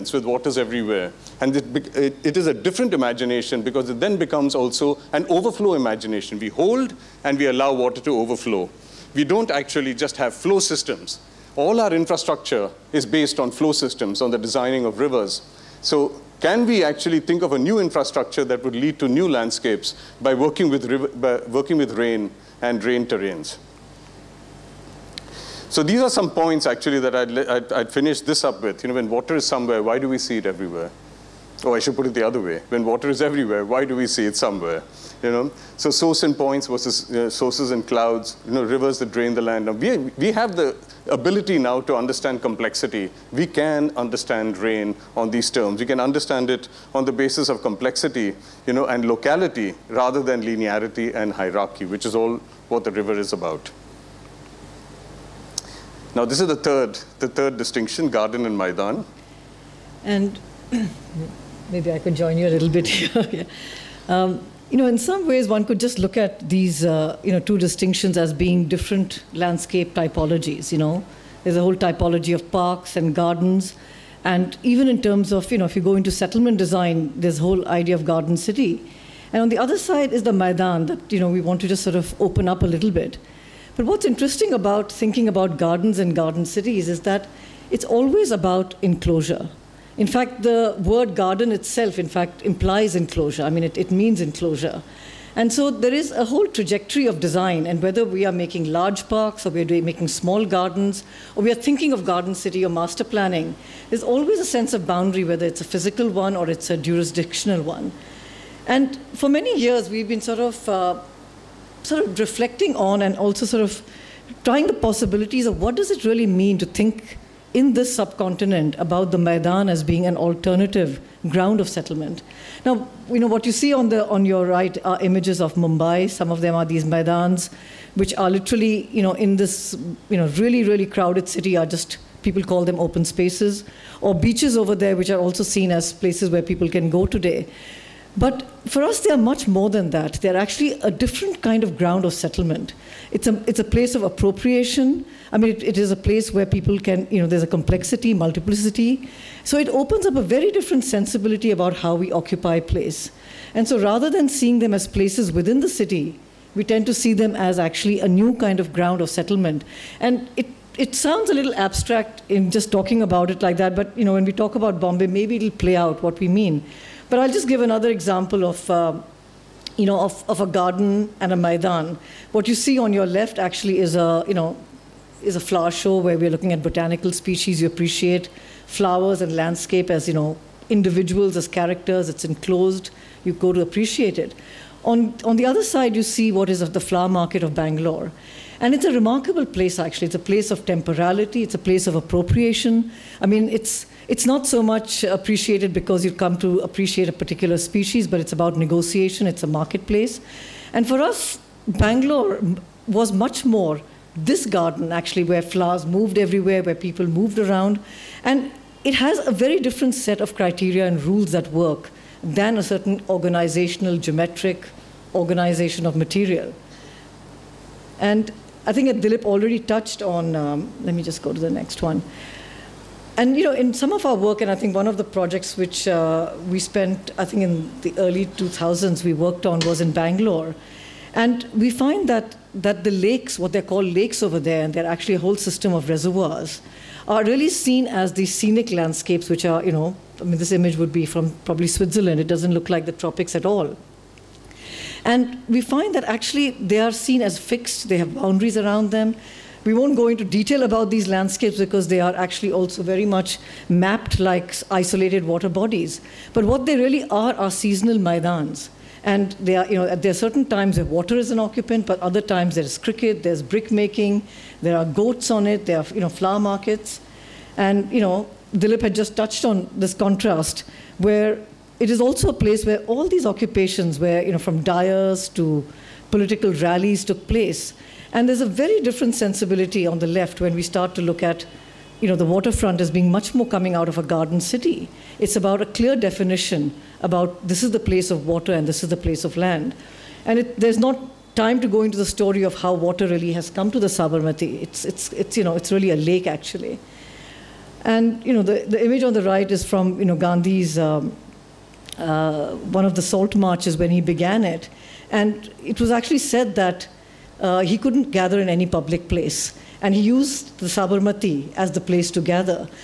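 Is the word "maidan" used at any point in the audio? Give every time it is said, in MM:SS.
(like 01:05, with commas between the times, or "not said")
00:58, 01:20, 01:59, 02:06, 02:51, 04:17.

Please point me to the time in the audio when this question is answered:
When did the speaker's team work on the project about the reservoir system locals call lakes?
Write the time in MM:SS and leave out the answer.
03:47.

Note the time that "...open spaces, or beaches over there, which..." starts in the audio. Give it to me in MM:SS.
02:12.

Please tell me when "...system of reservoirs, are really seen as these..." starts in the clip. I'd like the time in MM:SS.
03:55.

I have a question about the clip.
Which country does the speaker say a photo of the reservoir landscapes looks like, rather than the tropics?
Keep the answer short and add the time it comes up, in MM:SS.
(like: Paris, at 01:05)
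Switzerland, at 04:01.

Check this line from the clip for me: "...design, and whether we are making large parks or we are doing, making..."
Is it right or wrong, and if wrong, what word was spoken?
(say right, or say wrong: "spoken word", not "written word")
right.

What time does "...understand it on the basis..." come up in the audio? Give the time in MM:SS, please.
00:45.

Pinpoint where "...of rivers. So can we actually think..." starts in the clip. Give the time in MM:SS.
00:14.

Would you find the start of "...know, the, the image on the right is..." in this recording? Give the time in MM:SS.
04:58.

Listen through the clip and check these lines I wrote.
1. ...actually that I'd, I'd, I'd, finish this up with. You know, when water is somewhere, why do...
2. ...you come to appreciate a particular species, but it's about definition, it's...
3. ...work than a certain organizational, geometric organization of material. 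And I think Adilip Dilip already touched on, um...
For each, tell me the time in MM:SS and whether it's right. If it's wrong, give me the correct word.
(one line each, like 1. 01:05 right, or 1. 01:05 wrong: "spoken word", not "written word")
1. 00:26 right
2. 03:16 wrong: "negotiation", not "definition"
3. 03:31 right.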